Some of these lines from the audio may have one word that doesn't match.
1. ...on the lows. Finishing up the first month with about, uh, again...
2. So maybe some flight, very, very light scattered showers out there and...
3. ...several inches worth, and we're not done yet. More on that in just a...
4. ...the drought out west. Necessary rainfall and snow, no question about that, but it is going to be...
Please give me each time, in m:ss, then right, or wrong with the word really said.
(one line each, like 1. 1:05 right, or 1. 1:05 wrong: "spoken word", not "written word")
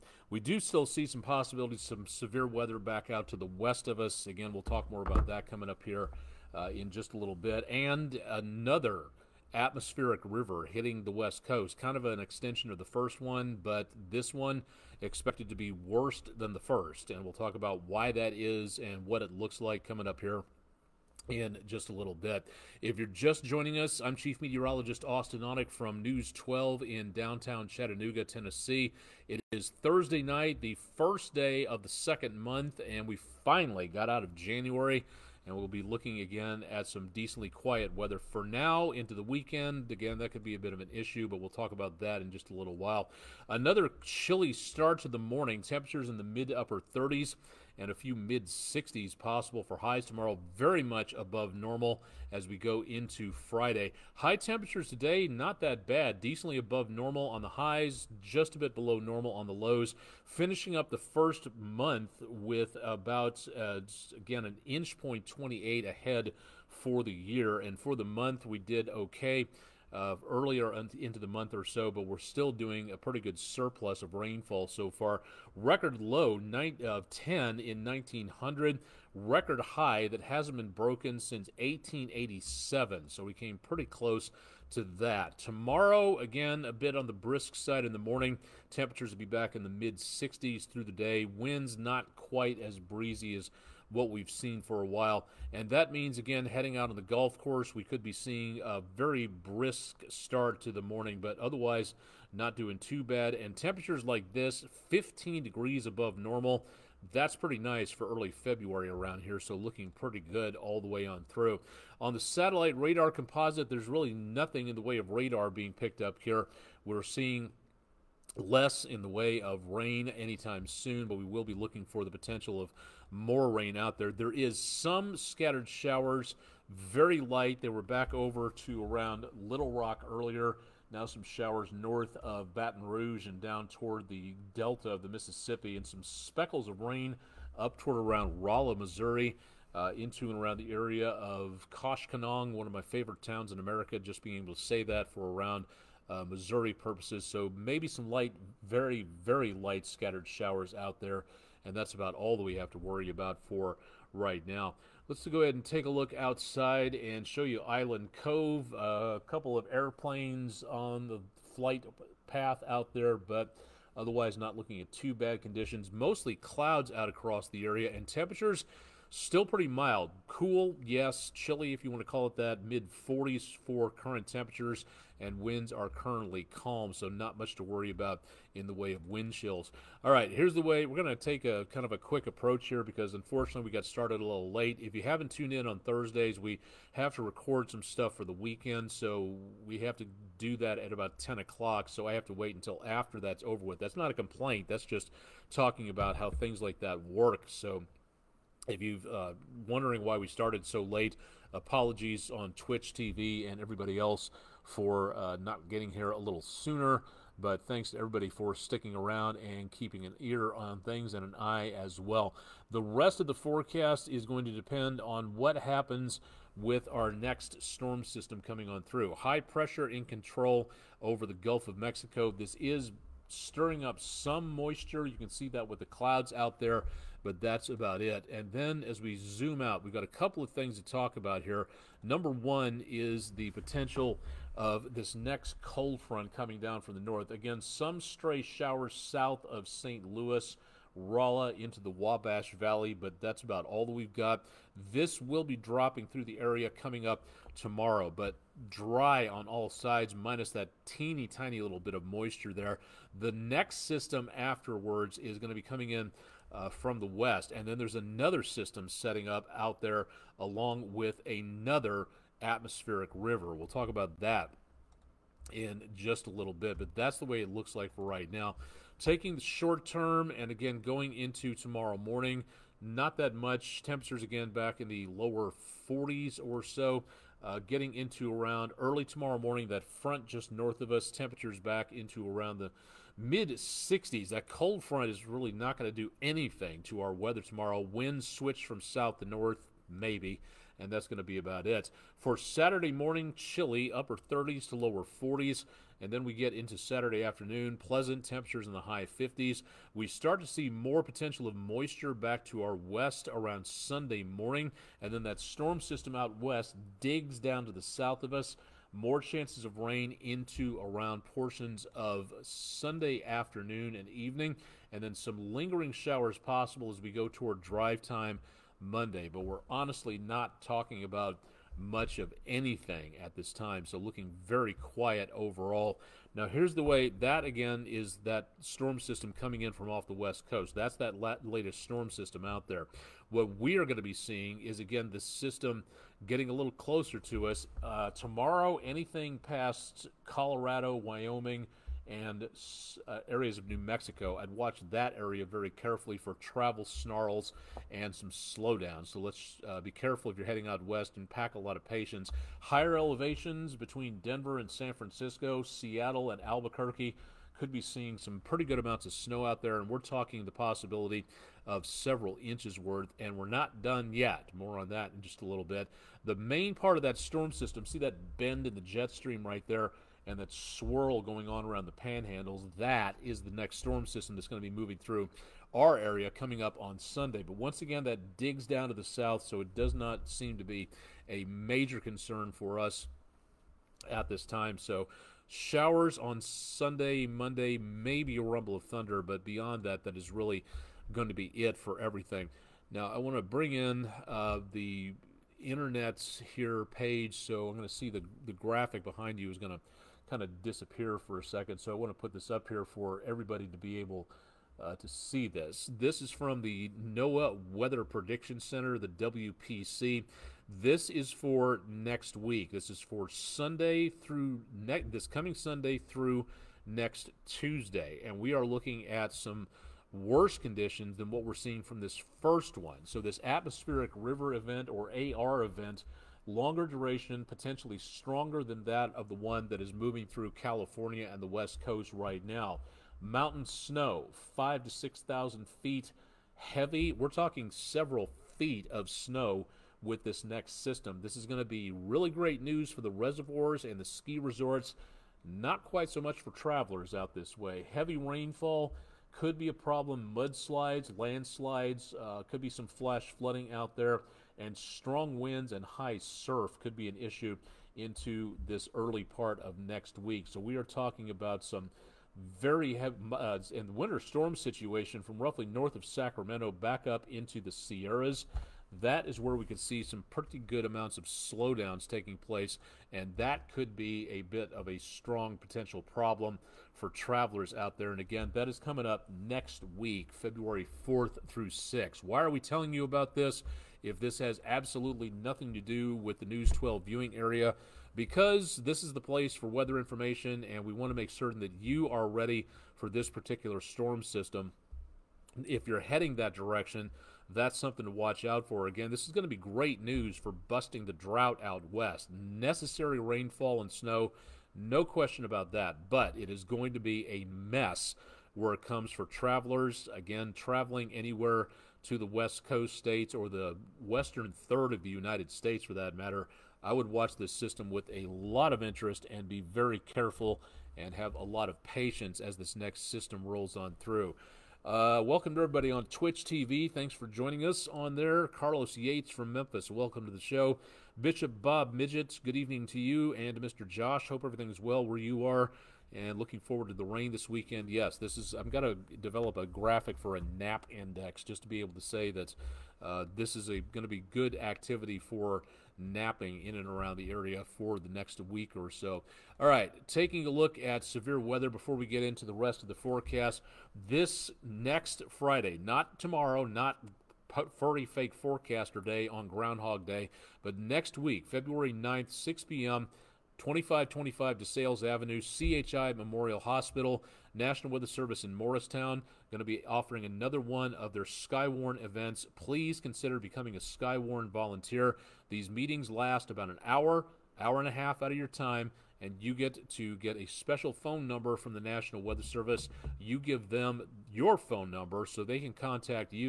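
1. 0:59 right
2. 2:27 wrong: "light", not "flight"
3. 6:01 right
4. 8:21 right.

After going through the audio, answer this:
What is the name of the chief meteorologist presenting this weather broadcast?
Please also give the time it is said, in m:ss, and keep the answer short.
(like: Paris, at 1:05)
Austen Onek, at 0:25.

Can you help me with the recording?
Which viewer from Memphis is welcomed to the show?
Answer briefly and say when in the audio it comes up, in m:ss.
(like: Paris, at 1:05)
Carlos Yates, at 8:48.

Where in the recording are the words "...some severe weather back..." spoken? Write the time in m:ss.
0:01.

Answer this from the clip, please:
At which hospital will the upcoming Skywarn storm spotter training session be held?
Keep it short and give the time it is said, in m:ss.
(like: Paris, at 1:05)
CHI Memorial Hospital, at 9:25.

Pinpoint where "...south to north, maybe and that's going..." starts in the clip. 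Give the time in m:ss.
4:48.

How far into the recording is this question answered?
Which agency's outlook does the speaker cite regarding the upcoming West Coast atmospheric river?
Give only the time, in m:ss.
6:47.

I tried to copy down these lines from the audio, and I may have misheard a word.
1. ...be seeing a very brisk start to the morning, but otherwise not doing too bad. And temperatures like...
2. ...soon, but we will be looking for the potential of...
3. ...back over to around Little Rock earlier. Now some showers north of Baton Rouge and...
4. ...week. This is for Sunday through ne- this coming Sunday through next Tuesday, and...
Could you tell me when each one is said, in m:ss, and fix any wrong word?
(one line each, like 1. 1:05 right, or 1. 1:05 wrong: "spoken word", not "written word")
1. 1:38 right
2. 2:00 right
3. 2:07 right
4. 6:52 right.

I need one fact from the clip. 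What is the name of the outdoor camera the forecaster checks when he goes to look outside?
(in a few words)
Island Cove.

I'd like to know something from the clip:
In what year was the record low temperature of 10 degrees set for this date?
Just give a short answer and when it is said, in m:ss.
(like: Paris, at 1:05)
1900, at 1:17.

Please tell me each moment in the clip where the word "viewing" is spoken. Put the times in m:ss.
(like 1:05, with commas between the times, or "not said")
8:07.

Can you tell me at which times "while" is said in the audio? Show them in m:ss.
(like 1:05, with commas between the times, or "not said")
0:42, 1:34.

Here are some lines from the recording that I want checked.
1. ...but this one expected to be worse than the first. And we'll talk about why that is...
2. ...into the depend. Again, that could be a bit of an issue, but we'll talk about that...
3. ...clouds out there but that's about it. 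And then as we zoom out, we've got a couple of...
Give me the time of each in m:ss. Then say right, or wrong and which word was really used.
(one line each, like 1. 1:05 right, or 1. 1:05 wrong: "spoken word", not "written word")
1. 0:13 right
2. 0:38 wrong: "weekend", not "depend"
3. 3:45 right.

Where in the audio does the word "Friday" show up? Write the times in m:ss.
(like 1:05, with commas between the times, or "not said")
0:53, 9:15.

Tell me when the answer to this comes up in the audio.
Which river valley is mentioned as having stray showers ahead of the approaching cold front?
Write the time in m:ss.
4:01.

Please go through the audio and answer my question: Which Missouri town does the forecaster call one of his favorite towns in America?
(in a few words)
Koshkonong.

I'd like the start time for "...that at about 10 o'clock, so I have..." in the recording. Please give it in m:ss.
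3:10.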